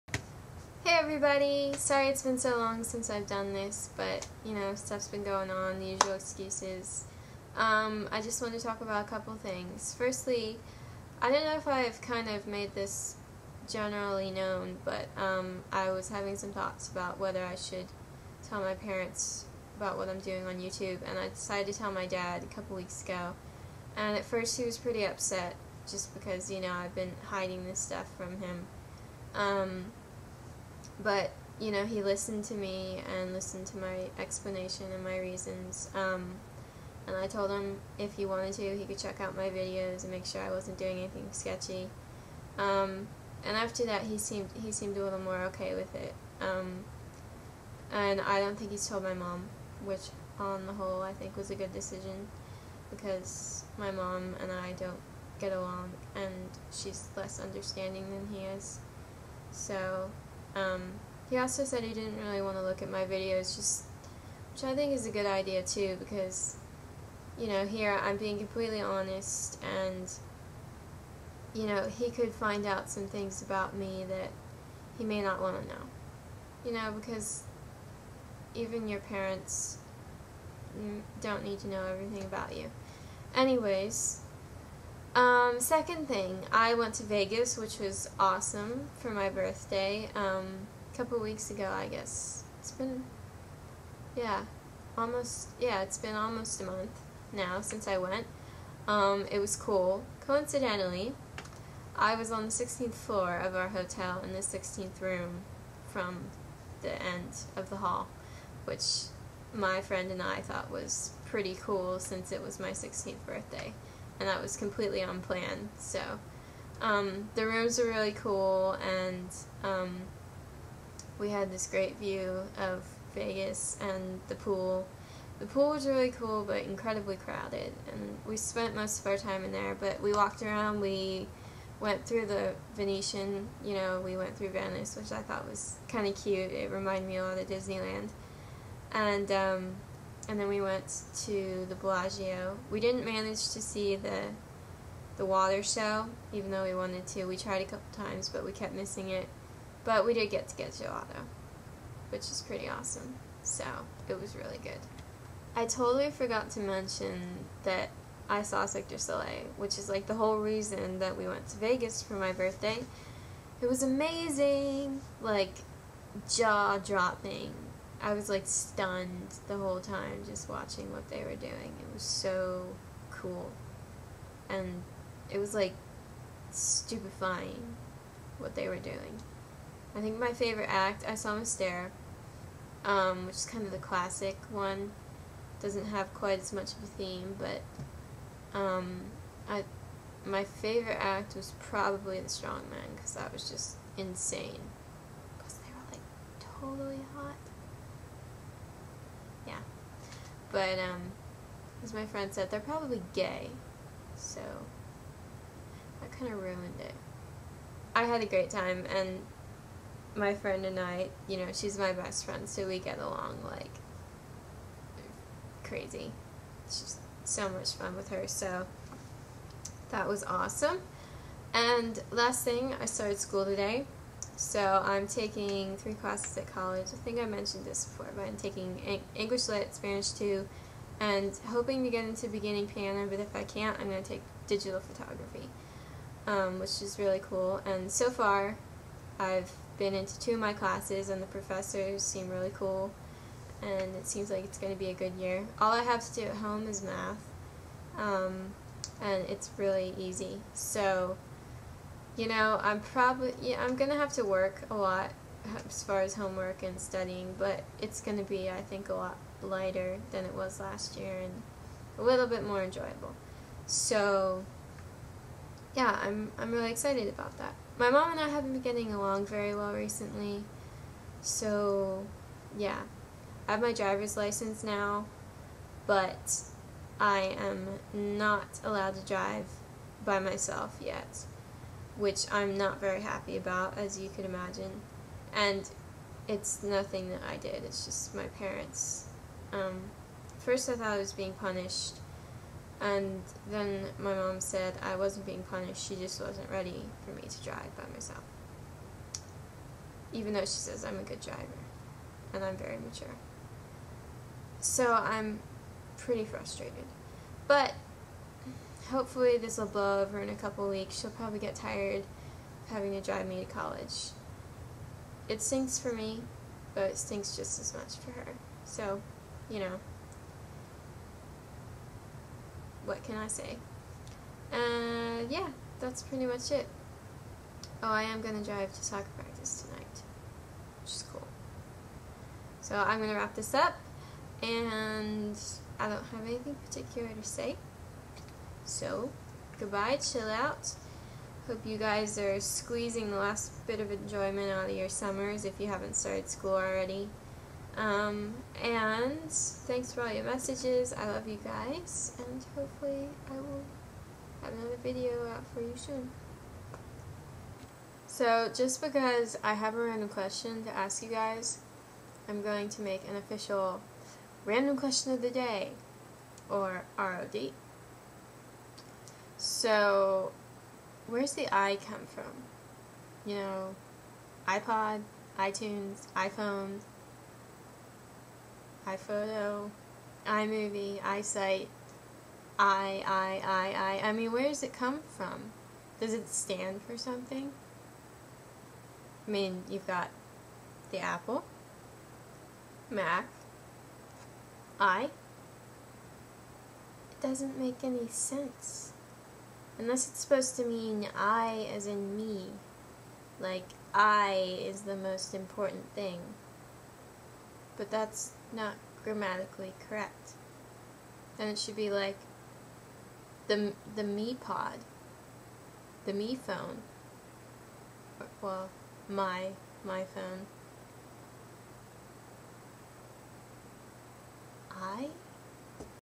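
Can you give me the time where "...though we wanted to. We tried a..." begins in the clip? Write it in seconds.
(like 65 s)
146 s.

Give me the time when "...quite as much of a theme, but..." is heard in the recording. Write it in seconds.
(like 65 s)
186 s.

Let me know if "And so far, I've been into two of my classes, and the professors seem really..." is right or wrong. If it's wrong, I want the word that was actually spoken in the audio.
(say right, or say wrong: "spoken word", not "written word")
right.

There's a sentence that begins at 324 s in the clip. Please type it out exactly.
Uh, yeah, that's pretty much it.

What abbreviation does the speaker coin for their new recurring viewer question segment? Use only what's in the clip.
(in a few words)
ROD.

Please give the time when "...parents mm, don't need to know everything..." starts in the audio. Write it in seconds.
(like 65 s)
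78 s.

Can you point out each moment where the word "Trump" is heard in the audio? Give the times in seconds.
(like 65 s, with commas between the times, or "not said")
not said.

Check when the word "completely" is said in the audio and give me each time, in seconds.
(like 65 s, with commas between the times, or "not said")
68 s, 114 s.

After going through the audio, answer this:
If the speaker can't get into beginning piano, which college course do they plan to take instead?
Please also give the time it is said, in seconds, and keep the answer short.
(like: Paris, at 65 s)
Digital photography, at 234 s.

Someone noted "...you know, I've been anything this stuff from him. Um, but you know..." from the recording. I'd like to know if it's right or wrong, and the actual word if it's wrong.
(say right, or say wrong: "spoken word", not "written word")
wrong: "hiding", not "anything".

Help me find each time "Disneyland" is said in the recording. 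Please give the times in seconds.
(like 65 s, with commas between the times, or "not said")
137 s.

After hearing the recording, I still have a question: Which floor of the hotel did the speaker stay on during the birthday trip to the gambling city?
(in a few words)
16th floor.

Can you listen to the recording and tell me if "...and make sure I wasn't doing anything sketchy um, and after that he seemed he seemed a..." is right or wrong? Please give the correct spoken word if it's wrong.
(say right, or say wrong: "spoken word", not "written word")
right.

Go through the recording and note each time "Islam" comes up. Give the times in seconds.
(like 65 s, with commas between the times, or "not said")
not said.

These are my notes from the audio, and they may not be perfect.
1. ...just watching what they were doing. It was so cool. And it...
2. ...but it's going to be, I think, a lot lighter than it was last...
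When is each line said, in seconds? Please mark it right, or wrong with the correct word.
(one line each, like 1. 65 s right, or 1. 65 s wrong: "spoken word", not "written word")
1. 170 s right
2. 257 s right.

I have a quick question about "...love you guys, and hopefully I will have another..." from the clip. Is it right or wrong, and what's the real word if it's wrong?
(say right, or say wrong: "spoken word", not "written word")
right.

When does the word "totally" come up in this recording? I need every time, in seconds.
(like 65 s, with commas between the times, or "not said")
155 s, 196 s.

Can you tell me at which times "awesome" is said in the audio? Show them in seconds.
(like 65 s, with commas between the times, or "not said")
88 s, 152 s, 220 s.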